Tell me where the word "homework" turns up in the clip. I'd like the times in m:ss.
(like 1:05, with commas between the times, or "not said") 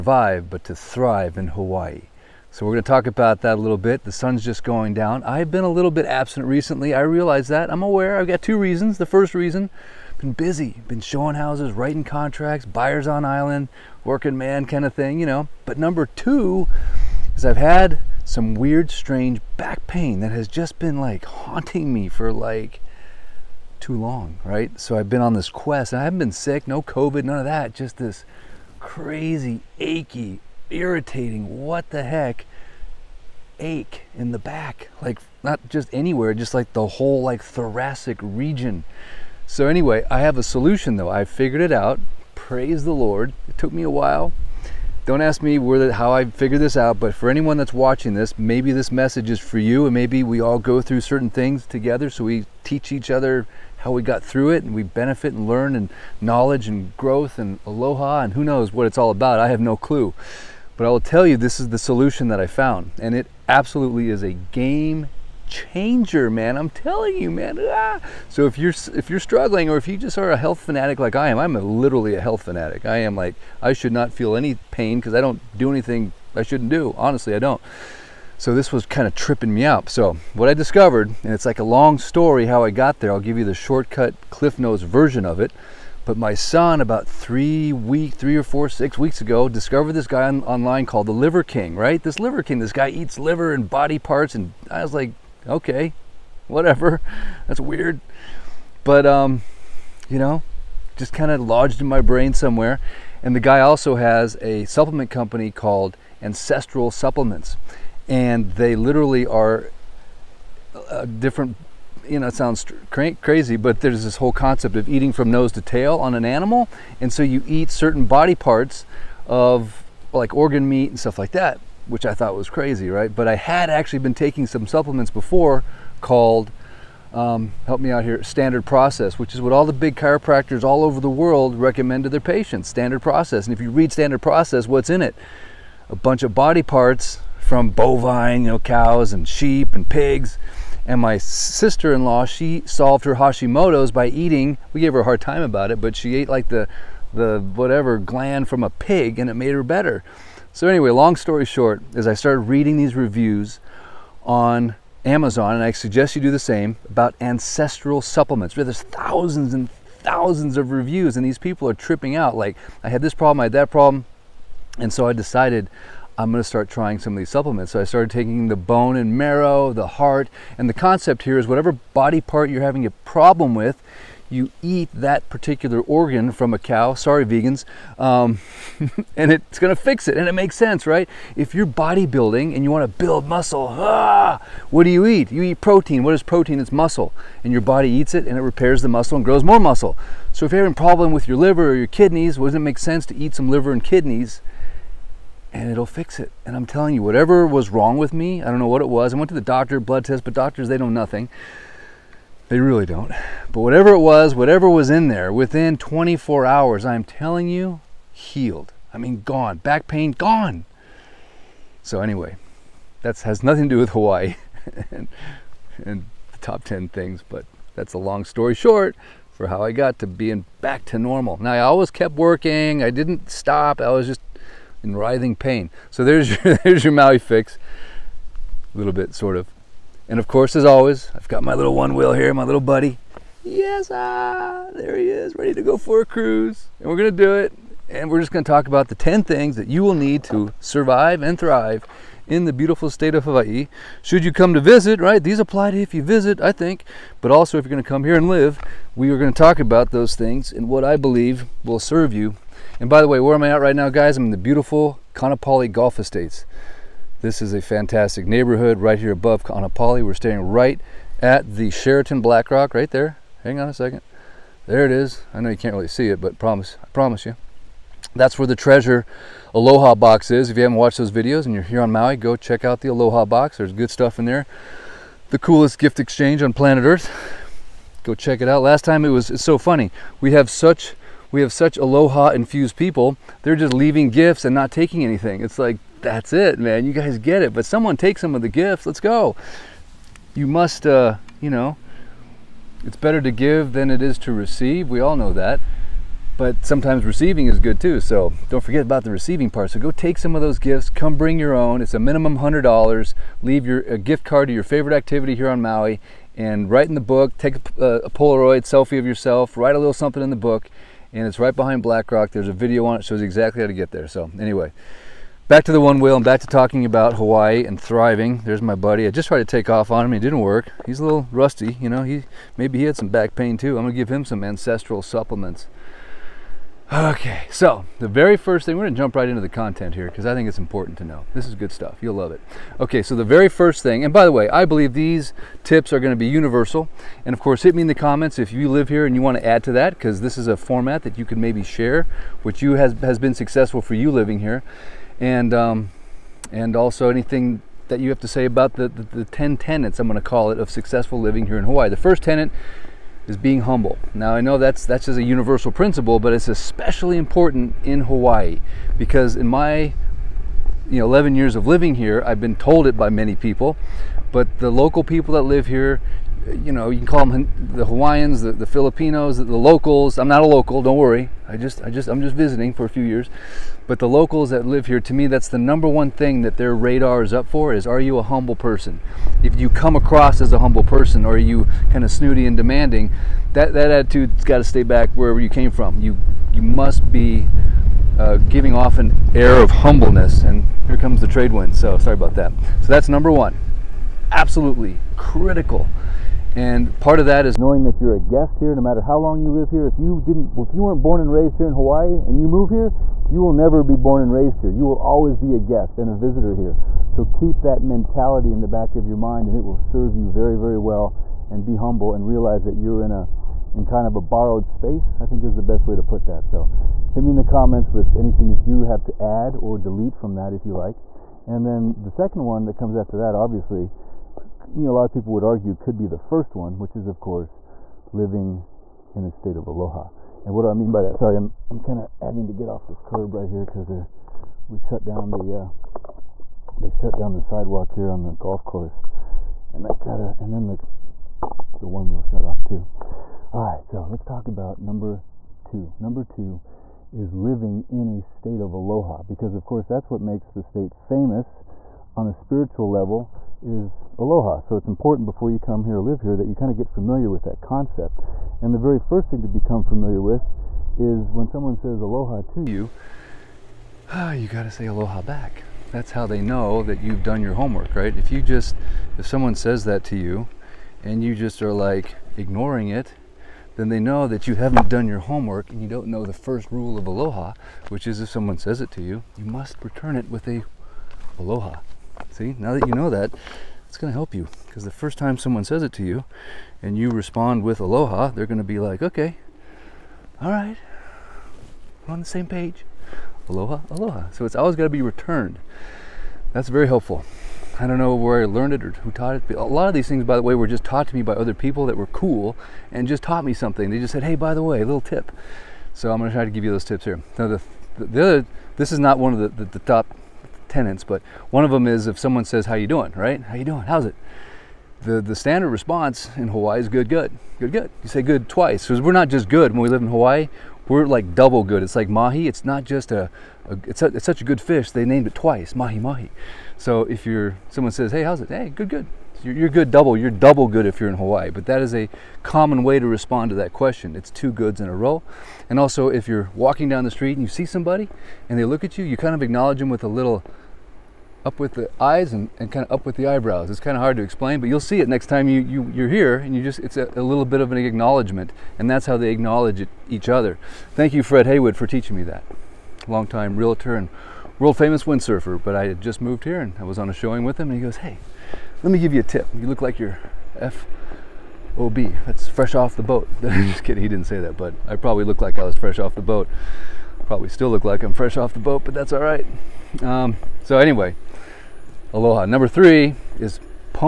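7:47, 7:55.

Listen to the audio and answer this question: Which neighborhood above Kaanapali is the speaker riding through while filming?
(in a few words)
Kaanapali Golf Estates.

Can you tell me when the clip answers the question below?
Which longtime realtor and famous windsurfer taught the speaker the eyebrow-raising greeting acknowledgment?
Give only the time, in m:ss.
9:11.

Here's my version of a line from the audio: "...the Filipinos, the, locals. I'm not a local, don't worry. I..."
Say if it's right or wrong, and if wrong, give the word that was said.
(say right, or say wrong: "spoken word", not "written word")
right.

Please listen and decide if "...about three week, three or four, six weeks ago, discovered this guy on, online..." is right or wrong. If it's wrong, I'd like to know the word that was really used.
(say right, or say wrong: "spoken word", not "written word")
right.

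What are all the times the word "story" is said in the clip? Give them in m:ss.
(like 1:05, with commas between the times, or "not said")
1:21, 2:31, 3:38.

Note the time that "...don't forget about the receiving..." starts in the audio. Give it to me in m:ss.
4:58.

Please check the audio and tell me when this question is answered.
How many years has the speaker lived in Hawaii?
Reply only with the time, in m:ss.
6:01.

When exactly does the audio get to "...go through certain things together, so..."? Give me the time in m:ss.
0:50.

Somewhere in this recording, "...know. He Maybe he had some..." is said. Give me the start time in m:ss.
5:21.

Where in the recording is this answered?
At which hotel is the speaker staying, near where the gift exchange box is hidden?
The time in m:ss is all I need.
4:21.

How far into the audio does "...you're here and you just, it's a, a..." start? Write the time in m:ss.
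9:05.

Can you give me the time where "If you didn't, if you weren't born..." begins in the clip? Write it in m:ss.
6:39.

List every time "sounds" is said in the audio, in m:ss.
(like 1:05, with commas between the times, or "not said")
1:52.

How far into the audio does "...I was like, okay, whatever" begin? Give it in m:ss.
1:34.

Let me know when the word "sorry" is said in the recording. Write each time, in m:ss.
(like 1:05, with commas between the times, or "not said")
2:56, 6:31, 7:11.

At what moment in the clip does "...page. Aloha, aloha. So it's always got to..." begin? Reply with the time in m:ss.
8:12.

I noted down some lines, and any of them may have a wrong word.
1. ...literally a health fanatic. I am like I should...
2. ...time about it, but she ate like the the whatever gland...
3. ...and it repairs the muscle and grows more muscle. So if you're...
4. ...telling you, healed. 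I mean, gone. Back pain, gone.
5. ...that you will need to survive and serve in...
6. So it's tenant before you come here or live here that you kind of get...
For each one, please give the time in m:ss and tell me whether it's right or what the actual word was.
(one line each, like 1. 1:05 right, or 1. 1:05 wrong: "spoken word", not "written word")
1. 1:11 right
2. 2:25 right
3. 3:08 right
4. 3:27 right
5. 3:59 wrong: "thrive", not "serve"
6. 7:34 wrong: "important", not "tenant".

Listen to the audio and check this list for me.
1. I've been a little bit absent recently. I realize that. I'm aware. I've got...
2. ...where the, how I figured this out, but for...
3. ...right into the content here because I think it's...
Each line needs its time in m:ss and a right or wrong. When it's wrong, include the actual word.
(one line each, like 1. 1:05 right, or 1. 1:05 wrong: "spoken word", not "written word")
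1. 0:05 right
2. 0:45 right
3. 5:29 right.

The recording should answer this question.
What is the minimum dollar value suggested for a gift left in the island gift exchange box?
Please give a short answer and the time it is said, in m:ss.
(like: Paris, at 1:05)
$100, at 5:02.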